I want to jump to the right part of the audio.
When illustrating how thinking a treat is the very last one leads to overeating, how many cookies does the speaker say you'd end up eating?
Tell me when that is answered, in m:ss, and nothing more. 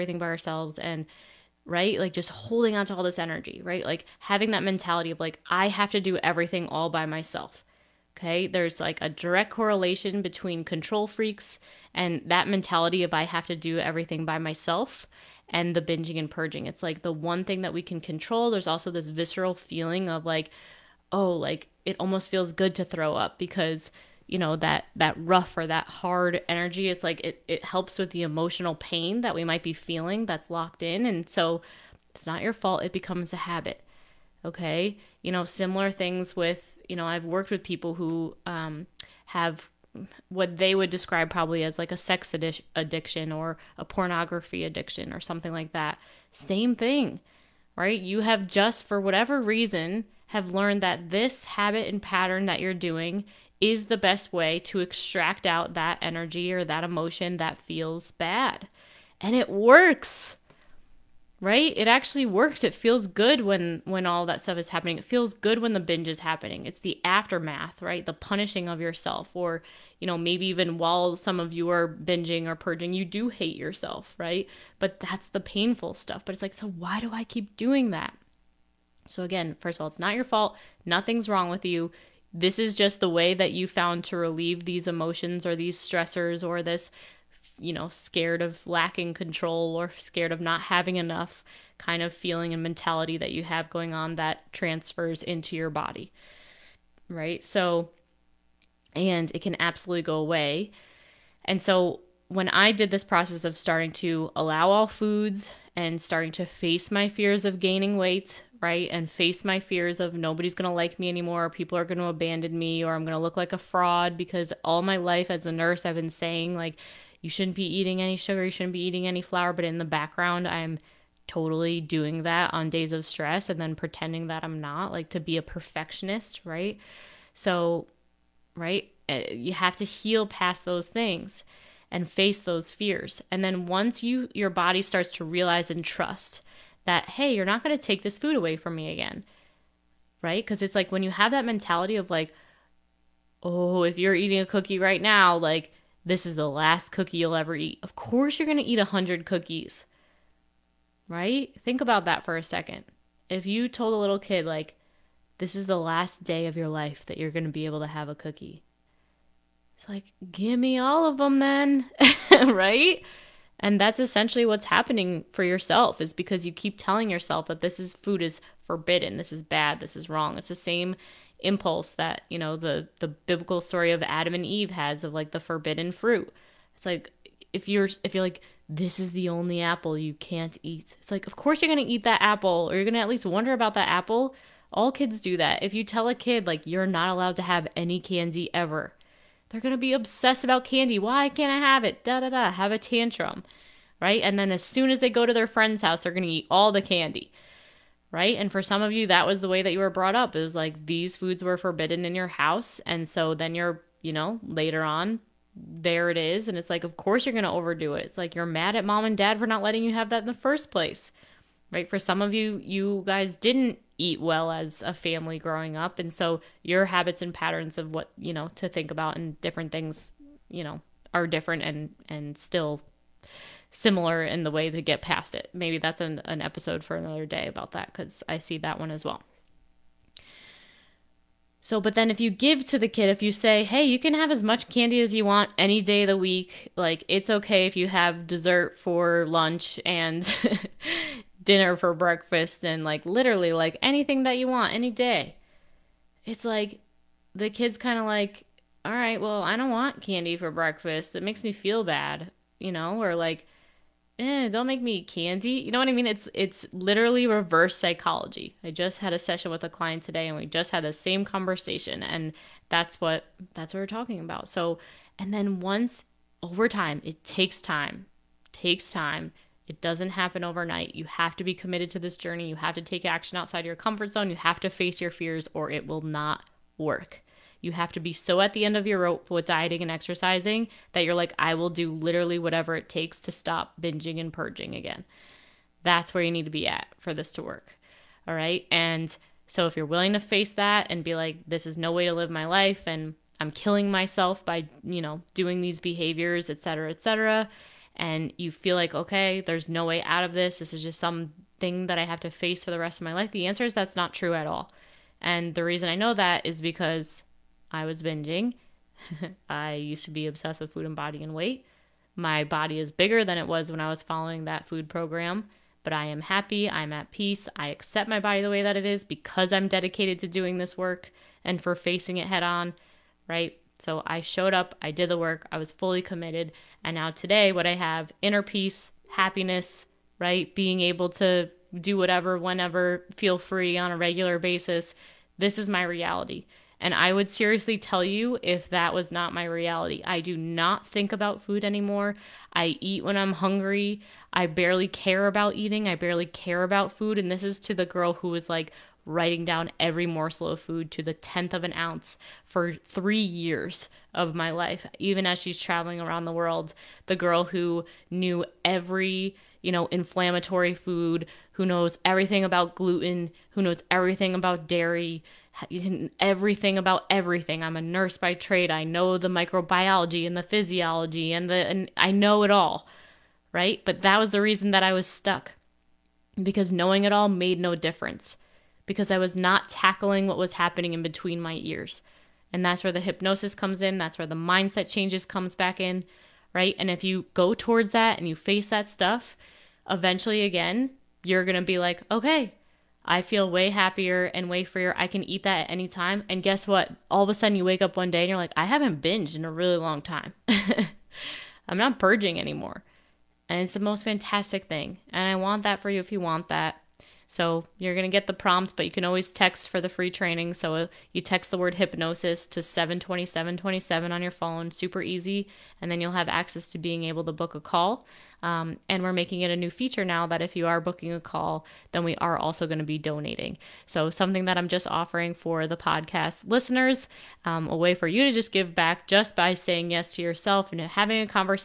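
2:28.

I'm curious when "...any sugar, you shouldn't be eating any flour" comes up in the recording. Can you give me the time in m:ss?
1:58.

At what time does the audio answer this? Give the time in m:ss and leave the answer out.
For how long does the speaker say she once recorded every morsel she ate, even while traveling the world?
5:52.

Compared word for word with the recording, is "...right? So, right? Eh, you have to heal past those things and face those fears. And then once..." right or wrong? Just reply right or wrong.
right.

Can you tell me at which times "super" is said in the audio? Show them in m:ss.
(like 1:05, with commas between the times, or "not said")
6:54.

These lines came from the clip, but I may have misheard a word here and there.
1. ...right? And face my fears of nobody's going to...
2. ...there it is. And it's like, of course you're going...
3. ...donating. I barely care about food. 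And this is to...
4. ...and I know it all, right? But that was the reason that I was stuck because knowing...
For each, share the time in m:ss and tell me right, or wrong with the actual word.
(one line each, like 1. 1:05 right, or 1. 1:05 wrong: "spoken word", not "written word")
1. 1:48 right
2. 3:25 right
3. 5:45 wrong: "eating", not "donating"
4. 6:11 right.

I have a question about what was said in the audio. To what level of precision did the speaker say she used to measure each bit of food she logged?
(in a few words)
tenth of an ounce.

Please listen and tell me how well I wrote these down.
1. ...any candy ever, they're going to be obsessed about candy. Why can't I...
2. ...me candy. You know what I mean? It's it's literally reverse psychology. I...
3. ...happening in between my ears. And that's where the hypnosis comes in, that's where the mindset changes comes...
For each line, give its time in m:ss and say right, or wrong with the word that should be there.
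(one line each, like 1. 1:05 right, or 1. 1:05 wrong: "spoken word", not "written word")
1. 3:07 right
2. 4:14 right
3. 6:20 right.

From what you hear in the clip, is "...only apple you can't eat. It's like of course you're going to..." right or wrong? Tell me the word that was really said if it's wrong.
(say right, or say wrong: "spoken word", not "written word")
right.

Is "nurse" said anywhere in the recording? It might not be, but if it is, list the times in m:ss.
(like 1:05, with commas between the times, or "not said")
1:55, 6:07.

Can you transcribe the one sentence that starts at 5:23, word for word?
So I showed up, I did the work, I was fully committed.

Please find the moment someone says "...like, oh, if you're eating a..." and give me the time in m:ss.
2:22.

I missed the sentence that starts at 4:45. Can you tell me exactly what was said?
That's where you need to be at for this to work.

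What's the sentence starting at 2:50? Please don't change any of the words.
It's the same impulse that, you know, the the biblical story of Adam and Eve has of like the forbidden fruit.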